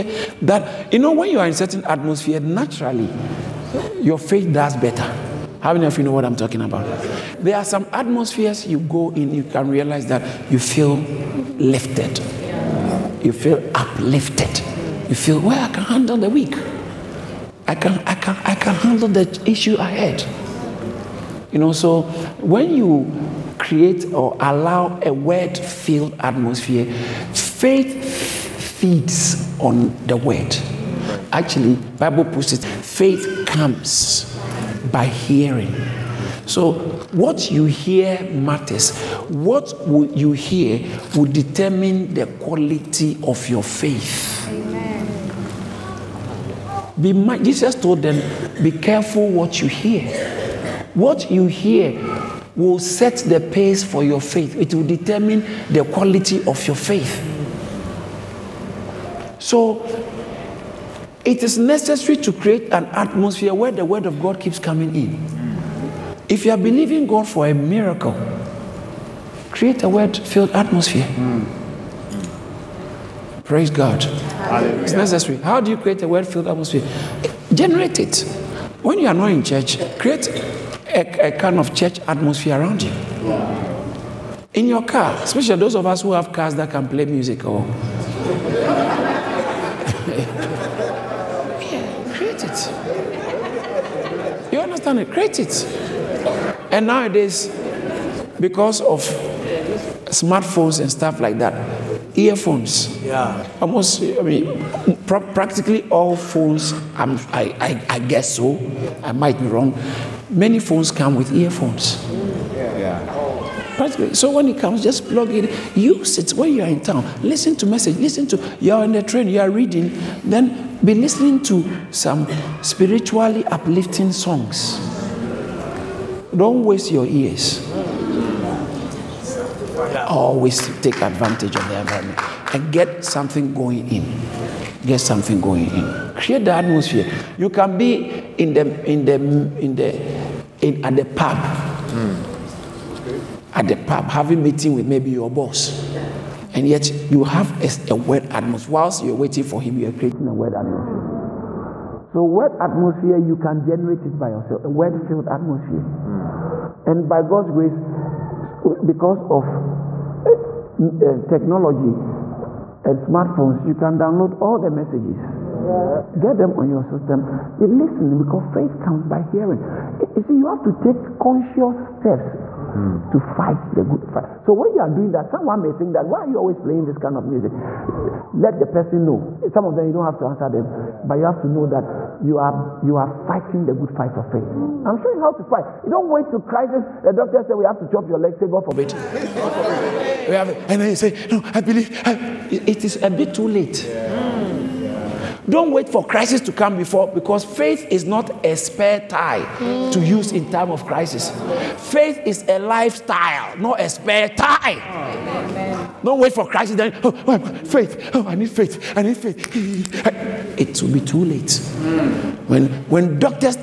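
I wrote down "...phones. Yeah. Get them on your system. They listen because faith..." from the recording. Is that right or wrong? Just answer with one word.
wrong.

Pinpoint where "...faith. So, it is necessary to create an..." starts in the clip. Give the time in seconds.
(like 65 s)
56 s.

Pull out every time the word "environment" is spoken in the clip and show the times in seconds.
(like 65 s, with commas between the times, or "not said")
131 s.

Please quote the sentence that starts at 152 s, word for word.
So wet atmosphere, you can generate it by yourself, a wet-filled atmosphere.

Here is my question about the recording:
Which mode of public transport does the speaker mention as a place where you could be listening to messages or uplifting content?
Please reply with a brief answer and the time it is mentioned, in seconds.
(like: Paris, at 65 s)
Train, at 119 s.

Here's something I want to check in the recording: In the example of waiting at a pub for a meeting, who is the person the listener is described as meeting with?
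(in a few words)
Your boss.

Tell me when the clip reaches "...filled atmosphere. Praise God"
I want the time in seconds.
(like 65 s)
70 s.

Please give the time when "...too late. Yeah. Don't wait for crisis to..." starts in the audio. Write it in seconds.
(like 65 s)
193 s.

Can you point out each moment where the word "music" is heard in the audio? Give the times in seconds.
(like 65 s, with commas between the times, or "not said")
87 s, 177 s.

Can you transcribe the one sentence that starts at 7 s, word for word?
There are some atmospheres you go in, you can realize that you feel lifted.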